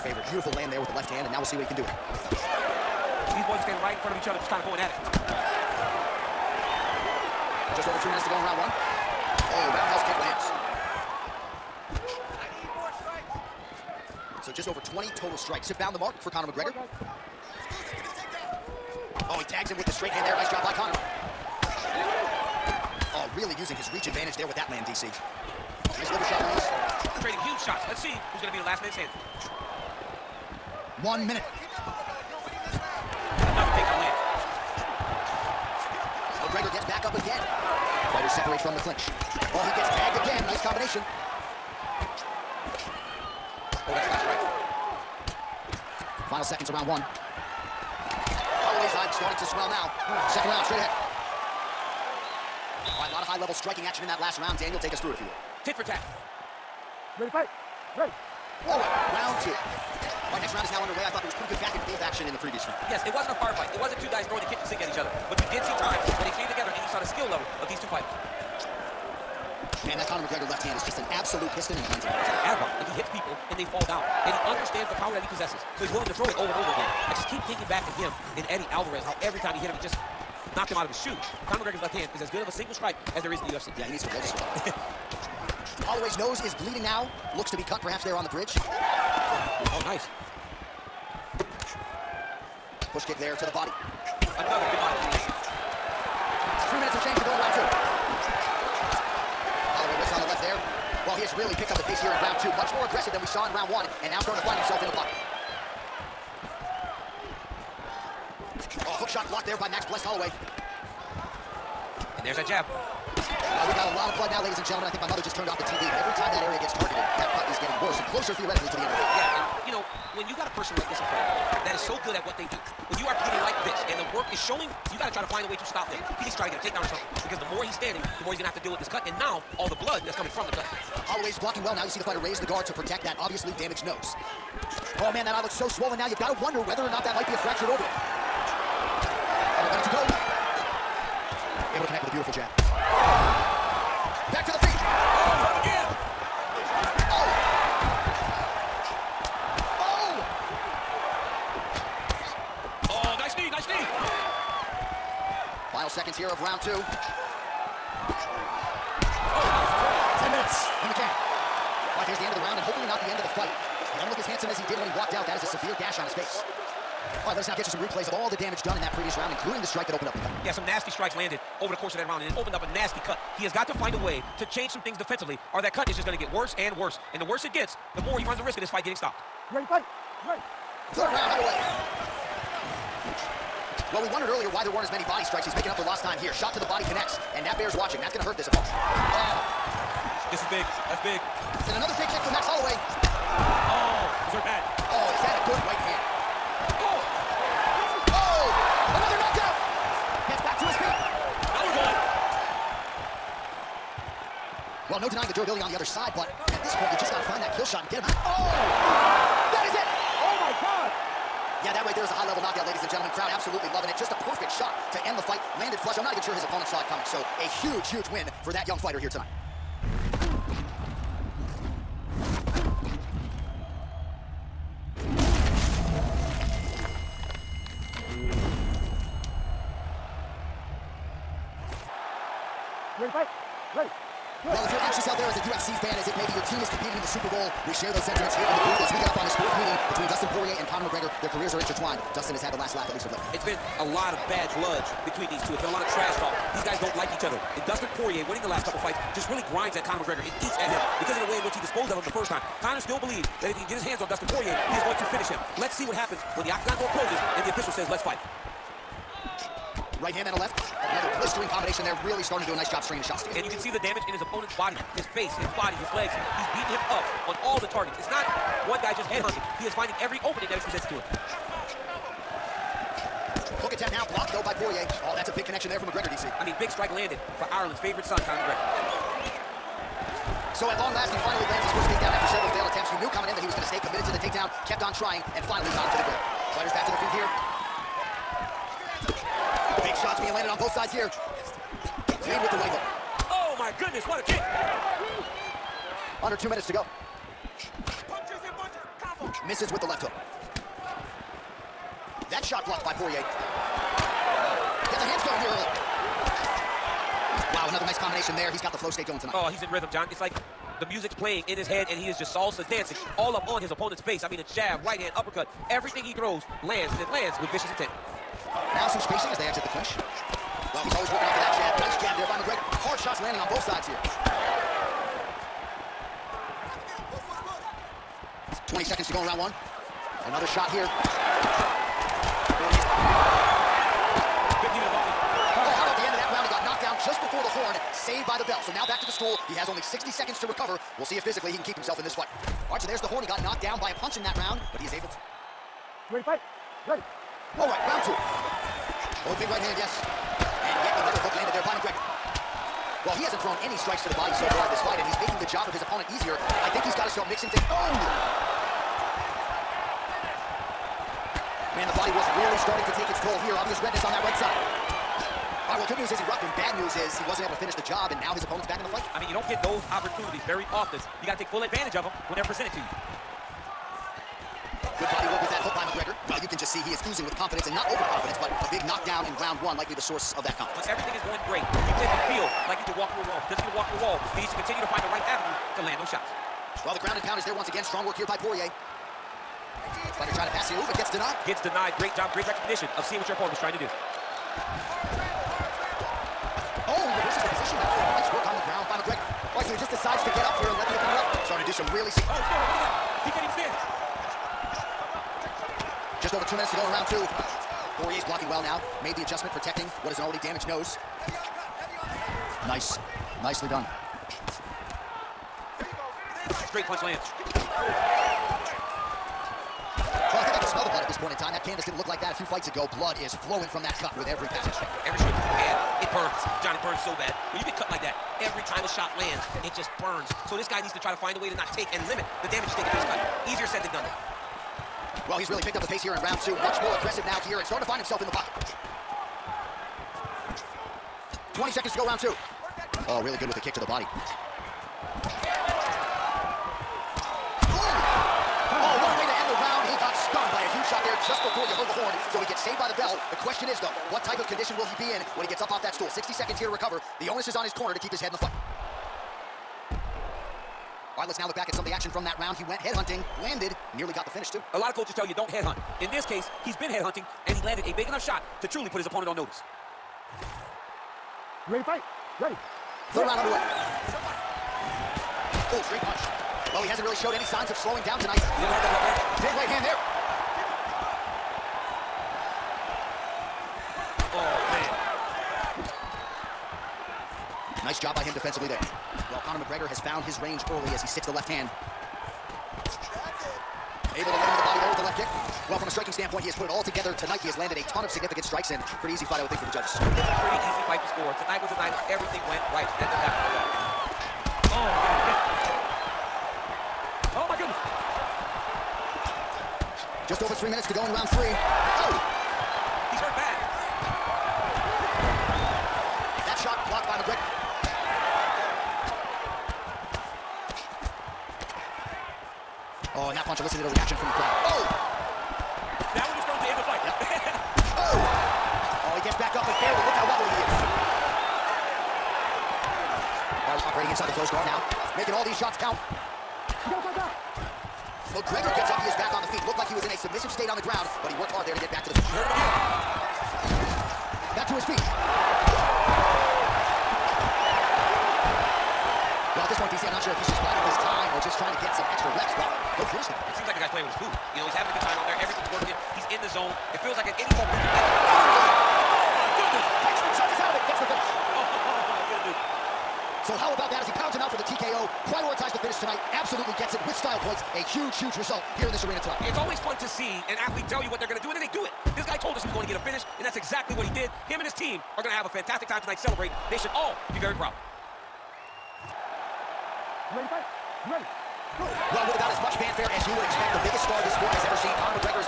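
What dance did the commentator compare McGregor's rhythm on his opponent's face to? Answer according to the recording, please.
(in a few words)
salsa.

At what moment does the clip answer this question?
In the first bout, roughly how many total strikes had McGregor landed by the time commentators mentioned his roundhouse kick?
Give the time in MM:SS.
00:14.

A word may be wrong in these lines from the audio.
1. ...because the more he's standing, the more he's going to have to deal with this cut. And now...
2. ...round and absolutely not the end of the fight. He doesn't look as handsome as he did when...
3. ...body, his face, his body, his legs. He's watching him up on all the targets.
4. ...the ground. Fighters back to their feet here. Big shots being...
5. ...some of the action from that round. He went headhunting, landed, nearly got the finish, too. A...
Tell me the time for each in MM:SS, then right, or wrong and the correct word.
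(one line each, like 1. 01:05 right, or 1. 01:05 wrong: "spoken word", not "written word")
1. 02:07 right
2. 02:42 wrong: "hopefully", not "absolutely"
3. 04:24 wrong: "beating", not "watching"
4. 04:45 right
5. 07:41 right.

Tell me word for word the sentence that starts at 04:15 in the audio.
Let's see what happens when the octagon door closes and the official says, let's fight.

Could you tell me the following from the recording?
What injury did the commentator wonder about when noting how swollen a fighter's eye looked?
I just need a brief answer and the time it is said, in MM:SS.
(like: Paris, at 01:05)
fractured orbital, at 02:17.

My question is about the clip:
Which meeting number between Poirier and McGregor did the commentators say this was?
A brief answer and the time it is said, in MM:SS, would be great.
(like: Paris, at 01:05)
fourth, at 03:59.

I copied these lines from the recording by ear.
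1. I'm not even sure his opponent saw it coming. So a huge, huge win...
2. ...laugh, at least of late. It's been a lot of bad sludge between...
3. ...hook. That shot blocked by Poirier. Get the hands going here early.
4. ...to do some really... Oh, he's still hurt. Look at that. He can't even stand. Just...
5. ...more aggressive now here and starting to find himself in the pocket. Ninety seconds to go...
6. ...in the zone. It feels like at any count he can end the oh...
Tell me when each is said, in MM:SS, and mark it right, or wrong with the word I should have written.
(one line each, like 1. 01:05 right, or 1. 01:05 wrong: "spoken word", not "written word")
1. 03:35 right
2. 04:02 right
3. 05:00 right
4. 06:41 right
5. 07:16 wrong: "Twenty", not "Ninety"
6. 09:16 wrong: "moment", not "count".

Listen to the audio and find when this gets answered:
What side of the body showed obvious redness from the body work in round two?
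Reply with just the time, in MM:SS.
06:04.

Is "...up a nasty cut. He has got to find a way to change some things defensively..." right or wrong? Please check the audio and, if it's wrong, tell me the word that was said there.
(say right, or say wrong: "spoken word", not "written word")
right.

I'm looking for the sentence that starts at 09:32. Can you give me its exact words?
This guy told us he was going to get a finish, and that's exactly what he did.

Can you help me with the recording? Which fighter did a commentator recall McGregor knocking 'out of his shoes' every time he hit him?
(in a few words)
Eddie Alvarez.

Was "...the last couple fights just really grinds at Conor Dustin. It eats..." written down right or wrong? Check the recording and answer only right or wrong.
wrong.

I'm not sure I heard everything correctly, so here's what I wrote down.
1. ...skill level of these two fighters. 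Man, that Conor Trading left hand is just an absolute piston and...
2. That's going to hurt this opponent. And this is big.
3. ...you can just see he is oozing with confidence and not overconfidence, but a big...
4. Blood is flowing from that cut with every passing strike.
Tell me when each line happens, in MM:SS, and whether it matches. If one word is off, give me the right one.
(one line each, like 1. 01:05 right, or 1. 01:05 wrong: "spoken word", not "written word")
1. 01:07 wrong: "McGregor", not "Trading"
2. 03:08 right
3. 06:16 right
4. 07:02 right.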